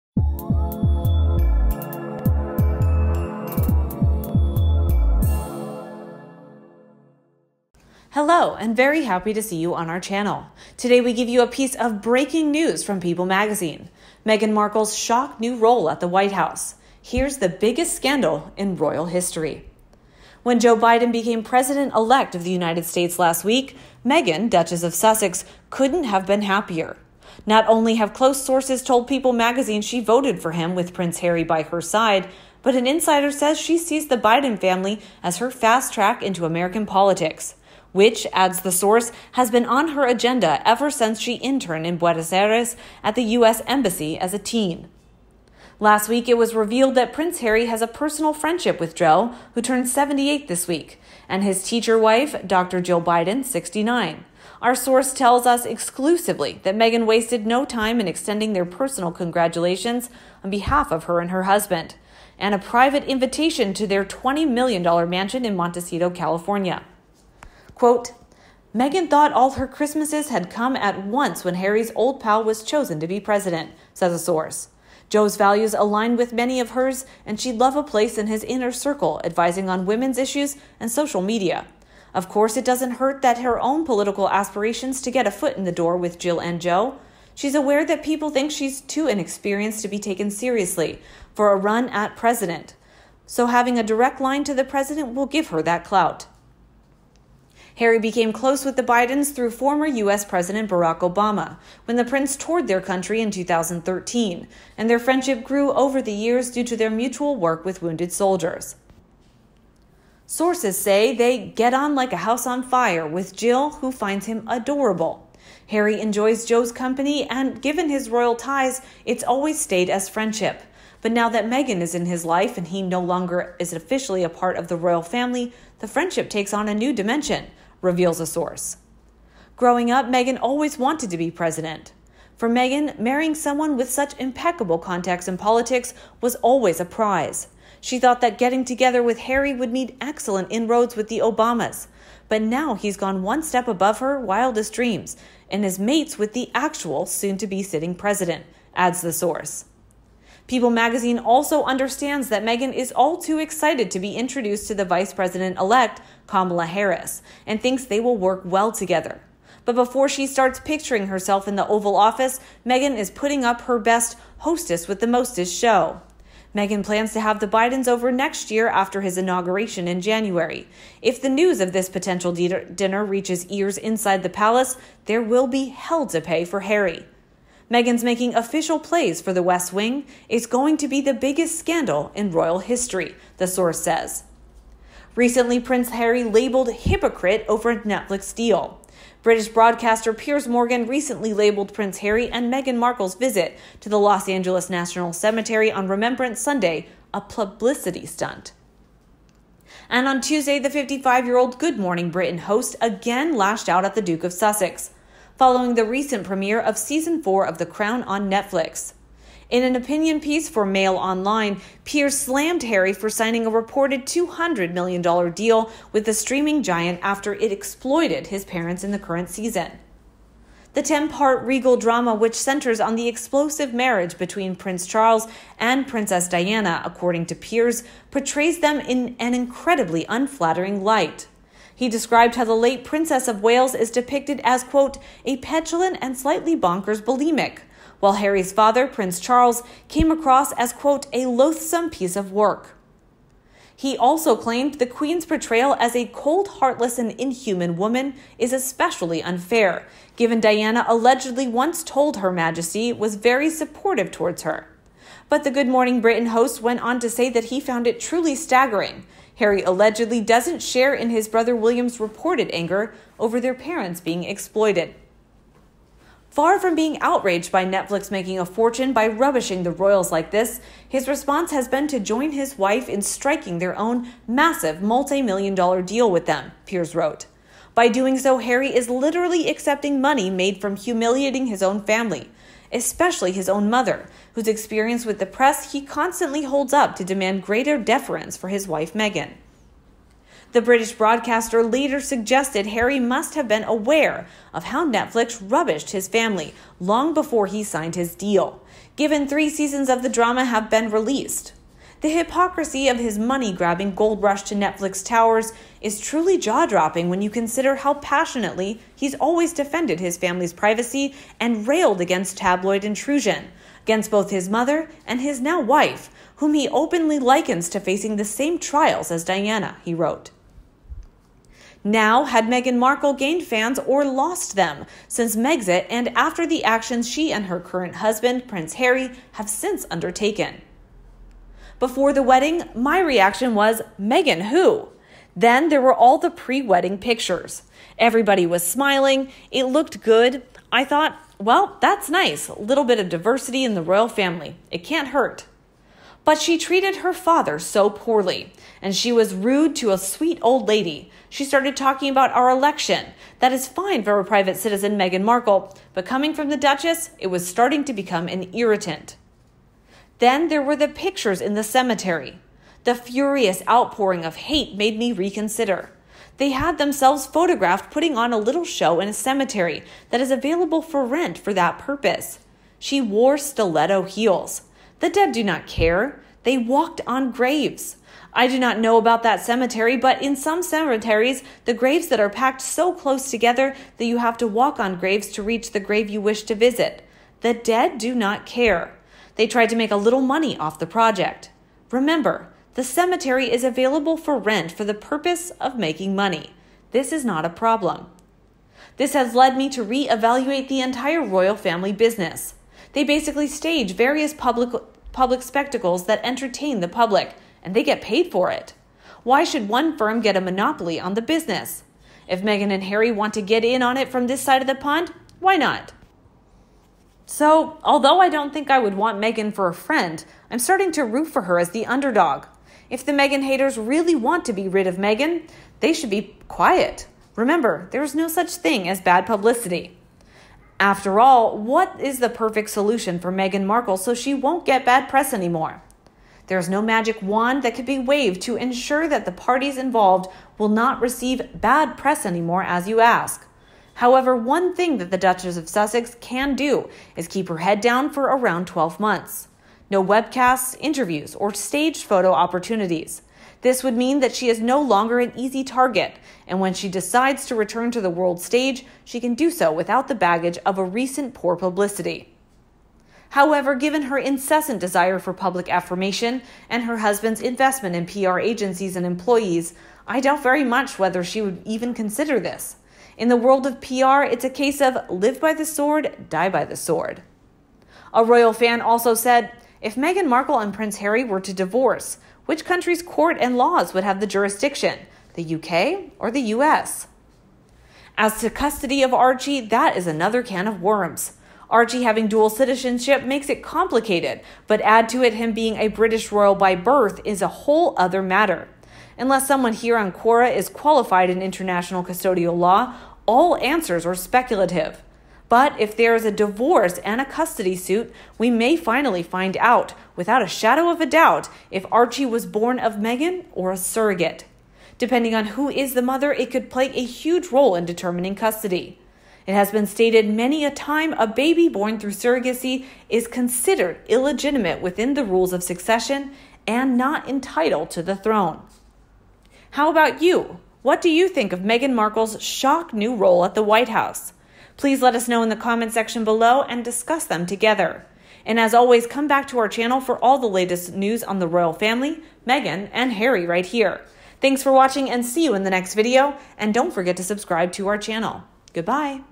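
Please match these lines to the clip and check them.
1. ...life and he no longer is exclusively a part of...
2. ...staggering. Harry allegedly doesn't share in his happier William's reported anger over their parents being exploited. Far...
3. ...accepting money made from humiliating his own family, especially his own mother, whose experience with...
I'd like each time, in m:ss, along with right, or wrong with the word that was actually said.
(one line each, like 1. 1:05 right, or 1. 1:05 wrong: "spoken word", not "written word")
1. 2:02 wrong: "officially", not "exclusively"
2. 4:18 wrong: "brother", not "happier"
3. 4:39 right.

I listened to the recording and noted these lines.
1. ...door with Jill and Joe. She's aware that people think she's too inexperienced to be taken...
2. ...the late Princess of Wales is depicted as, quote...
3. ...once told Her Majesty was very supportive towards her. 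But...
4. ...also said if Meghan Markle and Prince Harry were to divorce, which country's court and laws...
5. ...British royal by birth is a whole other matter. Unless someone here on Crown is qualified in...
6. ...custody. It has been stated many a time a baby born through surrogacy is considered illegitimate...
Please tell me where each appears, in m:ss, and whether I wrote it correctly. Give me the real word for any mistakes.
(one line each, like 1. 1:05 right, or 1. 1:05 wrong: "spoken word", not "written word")
1. 1:25 right
2. 3:52 right
3. 4:11 right
4. 7:58 right
5. 8:15 wrong: "Quora", not "Crown"
6. 8:38 right.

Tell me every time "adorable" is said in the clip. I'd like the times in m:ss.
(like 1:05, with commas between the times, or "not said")
1:54.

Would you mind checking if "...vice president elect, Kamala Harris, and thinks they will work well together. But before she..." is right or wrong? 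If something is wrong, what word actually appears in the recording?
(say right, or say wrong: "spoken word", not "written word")
right.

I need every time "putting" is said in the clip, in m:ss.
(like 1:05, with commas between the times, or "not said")
2:43, 6:07.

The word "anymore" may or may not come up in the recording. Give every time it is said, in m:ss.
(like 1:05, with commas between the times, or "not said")
7:15, 7:22.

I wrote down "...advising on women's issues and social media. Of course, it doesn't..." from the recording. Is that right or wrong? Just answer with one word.
right.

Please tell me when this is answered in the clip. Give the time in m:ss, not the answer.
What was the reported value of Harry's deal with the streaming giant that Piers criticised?
3:34.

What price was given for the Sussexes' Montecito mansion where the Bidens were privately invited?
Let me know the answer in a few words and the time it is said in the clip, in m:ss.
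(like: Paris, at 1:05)
$20 million, at 1:04.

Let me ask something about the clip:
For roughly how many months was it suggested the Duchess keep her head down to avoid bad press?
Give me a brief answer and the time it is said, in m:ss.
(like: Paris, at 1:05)
12 months, at 7:28.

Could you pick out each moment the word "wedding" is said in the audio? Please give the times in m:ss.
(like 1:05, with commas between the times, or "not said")
5:32, 5:36.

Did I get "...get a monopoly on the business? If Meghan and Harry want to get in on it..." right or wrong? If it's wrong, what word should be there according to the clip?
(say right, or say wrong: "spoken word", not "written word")
right.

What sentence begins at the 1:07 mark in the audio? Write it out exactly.
Quote, Meghan thought all her Christmases had come at once when Harry's old pal was chosen to be president, says a source.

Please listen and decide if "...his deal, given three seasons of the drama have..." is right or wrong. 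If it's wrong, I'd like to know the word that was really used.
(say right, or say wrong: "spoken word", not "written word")
right.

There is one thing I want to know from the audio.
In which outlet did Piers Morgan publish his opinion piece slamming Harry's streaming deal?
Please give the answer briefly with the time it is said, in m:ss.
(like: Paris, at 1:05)
Mail Online, at 3:30.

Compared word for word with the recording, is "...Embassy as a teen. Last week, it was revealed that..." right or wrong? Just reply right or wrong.
right.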